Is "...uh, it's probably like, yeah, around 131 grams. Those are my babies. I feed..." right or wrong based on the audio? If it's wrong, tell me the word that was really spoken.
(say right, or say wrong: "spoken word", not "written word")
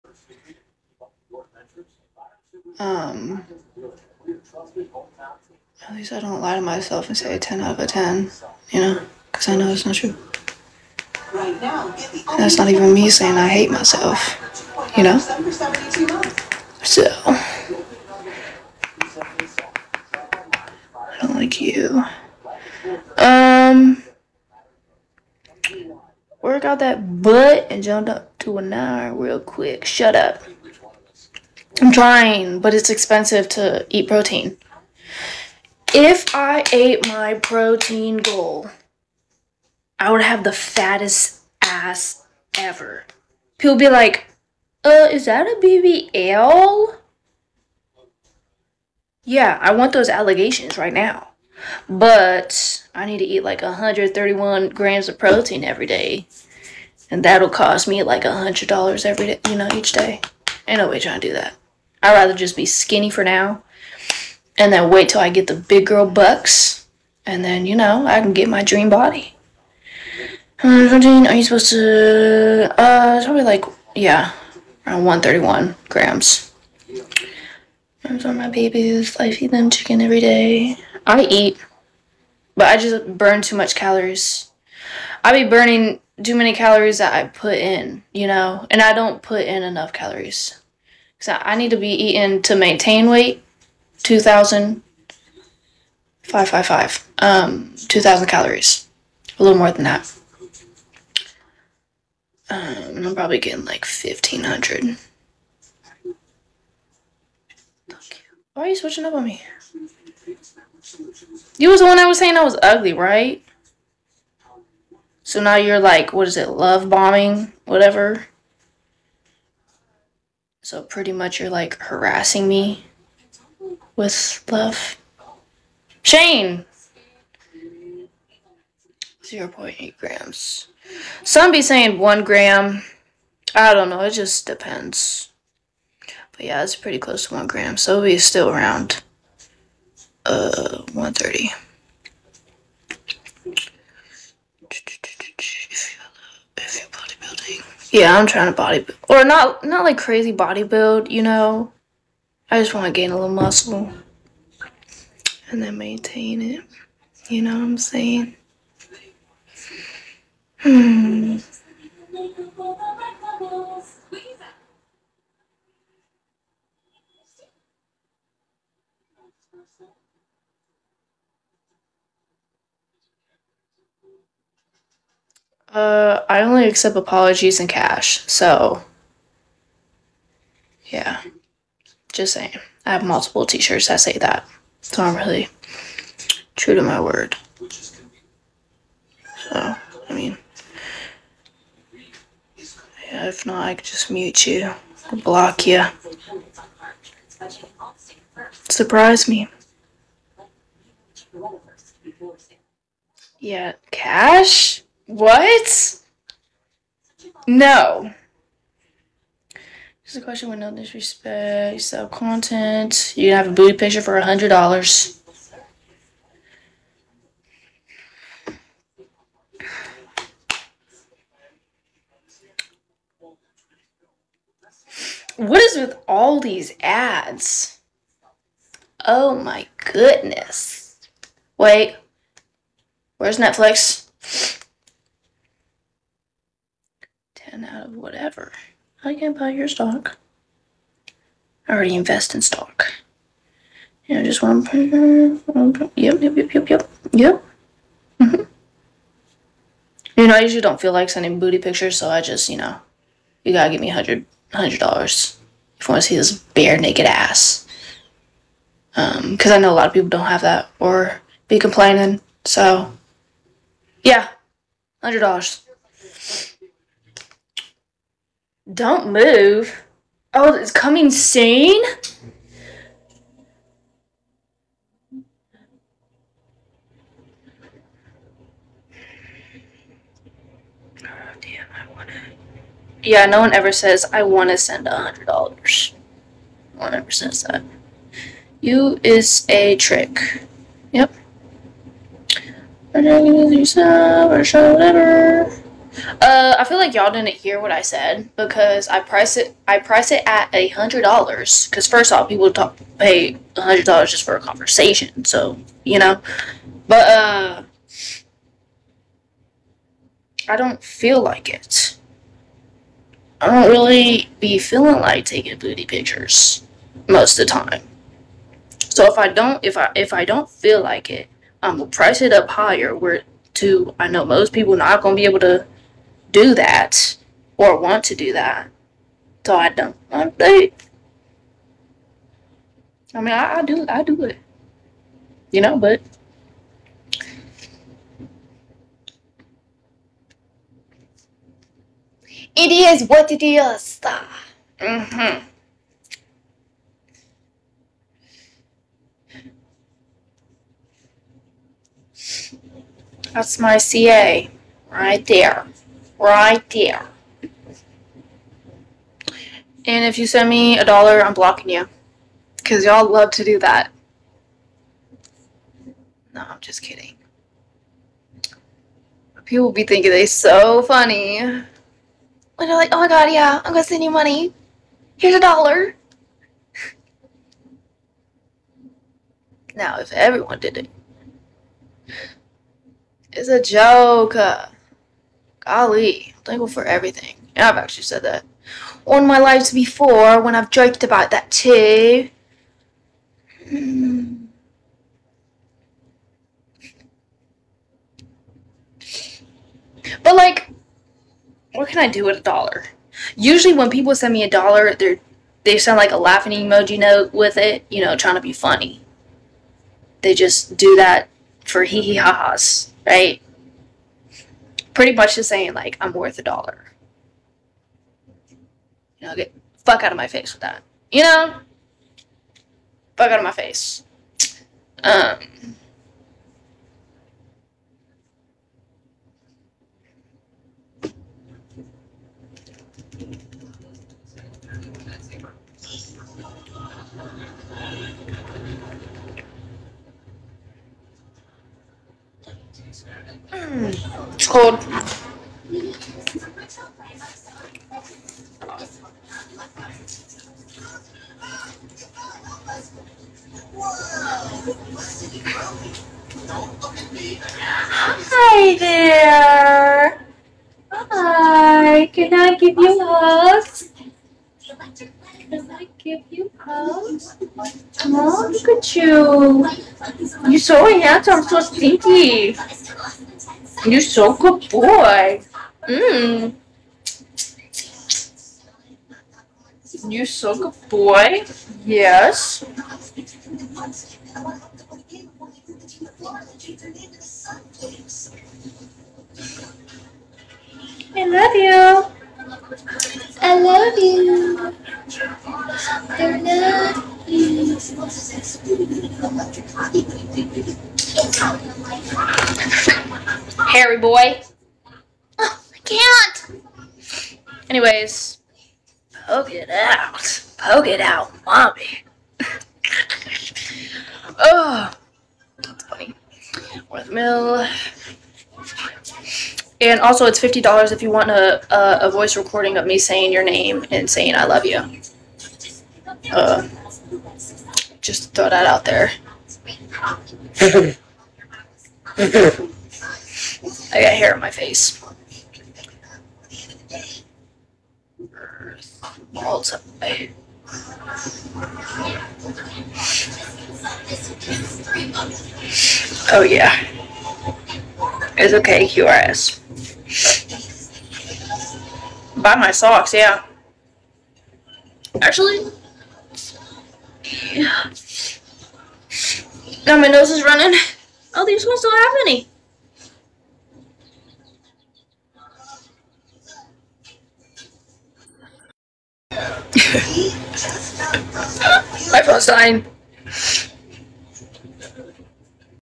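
right.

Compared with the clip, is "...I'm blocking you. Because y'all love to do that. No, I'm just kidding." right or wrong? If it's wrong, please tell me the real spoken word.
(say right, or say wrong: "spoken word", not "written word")
right.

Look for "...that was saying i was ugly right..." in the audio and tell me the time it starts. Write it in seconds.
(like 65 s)
111 s.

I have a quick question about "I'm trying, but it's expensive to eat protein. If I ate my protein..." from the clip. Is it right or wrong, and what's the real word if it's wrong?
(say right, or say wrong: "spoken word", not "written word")
right.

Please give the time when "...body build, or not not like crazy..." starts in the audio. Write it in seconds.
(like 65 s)
148 s.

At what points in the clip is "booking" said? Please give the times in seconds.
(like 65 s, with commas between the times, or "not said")
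not said.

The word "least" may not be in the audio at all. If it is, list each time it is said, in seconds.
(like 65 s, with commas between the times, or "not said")
5 s.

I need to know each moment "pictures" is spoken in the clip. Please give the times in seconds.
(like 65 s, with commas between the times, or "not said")
213 s, 251 s, 315 s.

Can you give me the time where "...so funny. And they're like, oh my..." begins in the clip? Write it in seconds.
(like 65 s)
370 s.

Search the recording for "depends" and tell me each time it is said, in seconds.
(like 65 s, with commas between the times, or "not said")
134 s.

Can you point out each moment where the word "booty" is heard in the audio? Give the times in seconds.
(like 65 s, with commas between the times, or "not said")
213 s, 251 s, 315 s.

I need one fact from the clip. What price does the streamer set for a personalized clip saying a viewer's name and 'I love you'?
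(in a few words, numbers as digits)
$50.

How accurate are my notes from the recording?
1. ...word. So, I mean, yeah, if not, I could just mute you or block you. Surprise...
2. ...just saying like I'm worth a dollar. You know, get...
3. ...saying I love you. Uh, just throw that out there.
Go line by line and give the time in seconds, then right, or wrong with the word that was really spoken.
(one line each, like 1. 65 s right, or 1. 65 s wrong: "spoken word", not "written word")
1. 186 s right
2. 415 s right
3. 524 s right.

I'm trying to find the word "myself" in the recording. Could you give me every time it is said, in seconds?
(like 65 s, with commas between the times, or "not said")
6 s, 13 s.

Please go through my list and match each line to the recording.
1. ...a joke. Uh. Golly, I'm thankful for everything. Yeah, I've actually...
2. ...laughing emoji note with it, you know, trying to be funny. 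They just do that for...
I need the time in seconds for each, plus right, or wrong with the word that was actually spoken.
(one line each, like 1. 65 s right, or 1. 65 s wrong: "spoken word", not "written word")
1. 383 s right
2. 406 s right.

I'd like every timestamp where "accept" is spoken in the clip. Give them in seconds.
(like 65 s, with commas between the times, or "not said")
176 s.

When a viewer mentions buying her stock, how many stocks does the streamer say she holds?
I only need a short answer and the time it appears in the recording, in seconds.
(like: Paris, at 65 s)
1, at 244 s.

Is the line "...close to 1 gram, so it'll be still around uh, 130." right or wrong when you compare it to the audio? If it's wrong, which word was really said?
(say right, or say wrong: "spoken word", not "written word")
right.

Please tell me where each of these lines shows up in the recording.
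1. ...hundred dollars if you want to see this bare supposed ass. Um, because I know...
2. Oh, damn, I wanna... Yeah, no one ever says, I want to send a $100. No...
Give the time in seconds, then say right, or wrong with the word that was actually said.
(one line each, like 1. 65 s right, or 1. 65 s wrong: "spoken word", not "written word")
1. 254 s wrong: "naked", not "supposed"
2. 281 s right.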